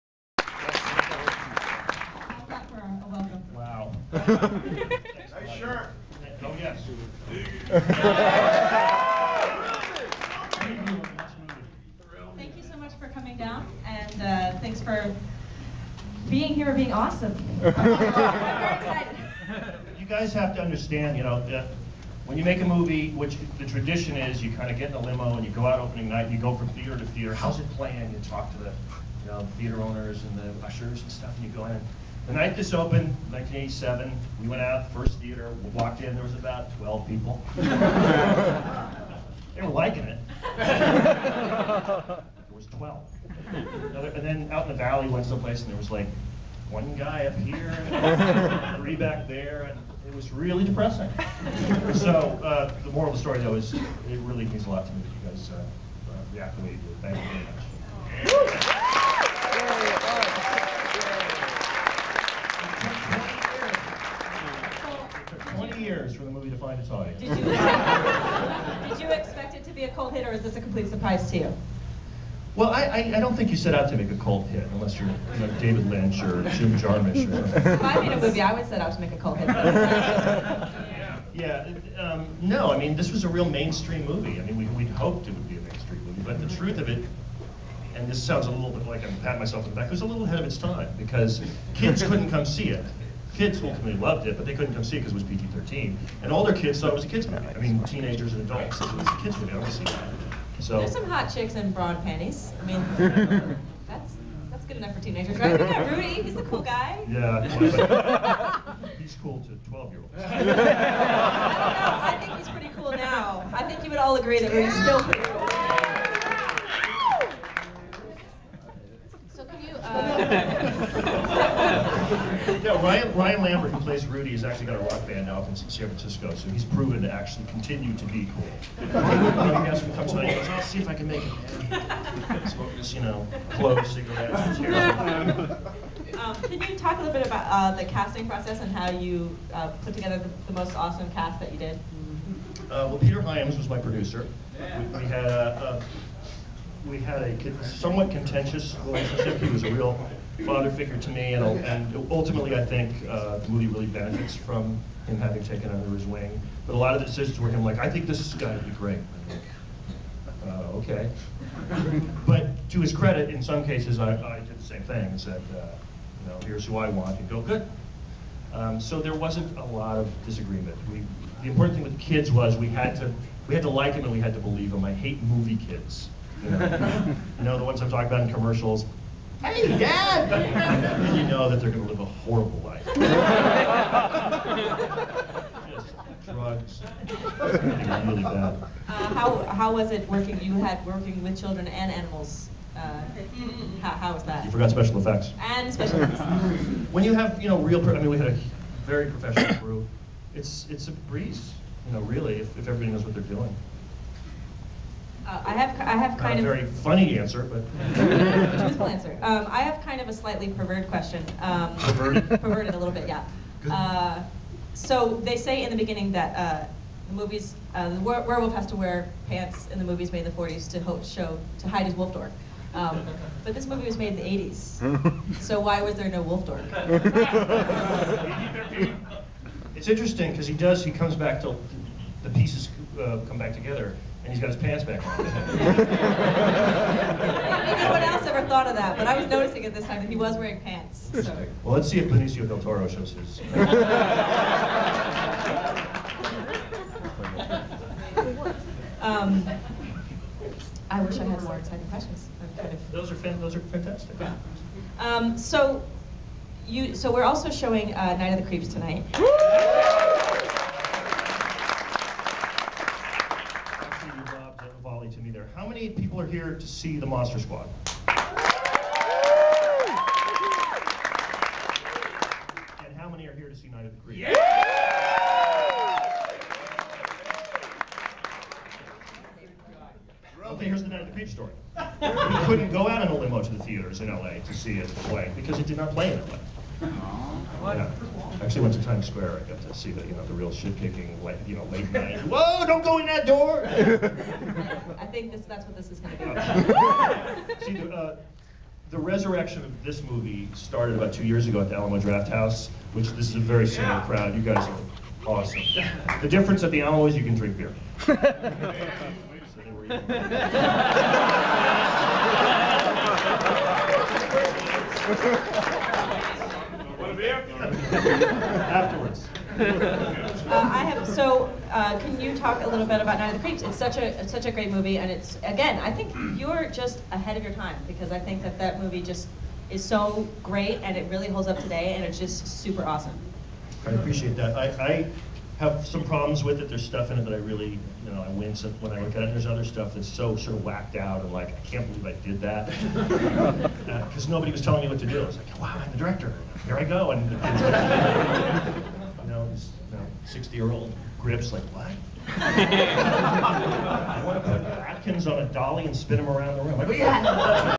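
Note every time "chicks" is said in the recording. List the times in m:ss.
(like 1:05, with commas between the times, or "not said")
1:41.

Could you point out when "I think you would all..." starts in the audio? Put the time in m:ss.
1:53.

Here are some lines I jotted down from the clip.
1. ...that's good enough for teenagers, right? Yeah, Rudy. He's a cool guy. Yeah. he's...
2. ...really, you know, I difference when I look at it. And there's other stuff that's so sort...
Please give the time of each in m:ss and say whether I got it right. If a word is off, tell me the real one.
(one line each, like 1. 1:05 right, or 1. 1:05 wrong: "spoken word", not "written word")
1. 1:44 right
2. 5:37 wrong: "wince", not "difference".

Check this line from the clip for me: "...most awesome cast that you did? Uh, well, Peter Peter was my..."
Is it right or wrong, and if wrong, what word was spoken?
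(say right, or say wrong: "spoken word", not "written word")
wrong: "Hyams", not "Peter".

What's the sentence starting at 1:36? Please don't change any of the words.
And older kids thought it was a kids movie.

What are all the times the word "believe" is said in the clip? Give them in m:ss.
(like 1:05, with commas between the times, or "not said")
2:54, 5:41.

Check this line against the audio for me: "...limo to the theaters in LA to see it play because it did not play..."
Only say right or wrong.
right.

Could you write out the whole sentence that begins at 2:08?
you know, to tonight, he goes, I'll see if I can make it, man.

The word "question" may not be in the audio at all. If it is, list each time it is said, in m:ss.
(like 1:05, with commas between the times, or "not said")
3:30, 4:11.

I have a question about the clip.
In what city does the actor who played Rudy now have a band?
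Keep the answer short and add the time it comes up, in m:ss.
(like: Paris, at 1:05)
San Francisco, at 2:05.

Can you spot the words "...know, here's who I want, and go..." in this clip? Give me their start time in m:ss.
2:46.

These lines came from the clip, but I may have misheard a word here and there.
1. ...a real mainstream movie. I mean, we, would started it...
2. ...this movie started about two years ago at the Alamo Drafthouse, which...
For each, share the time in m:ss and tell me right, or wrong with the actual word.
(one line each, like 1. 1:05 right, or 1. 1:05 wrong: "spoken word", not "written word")
1. 1:23 wrong: "hoped", not "started"
2. 4:59 right.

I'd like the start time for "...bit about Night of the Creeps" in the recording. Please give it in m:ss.
5:22.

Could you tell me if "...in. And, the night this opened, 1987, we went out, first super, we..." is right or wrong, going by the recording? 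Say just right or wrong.
wrong.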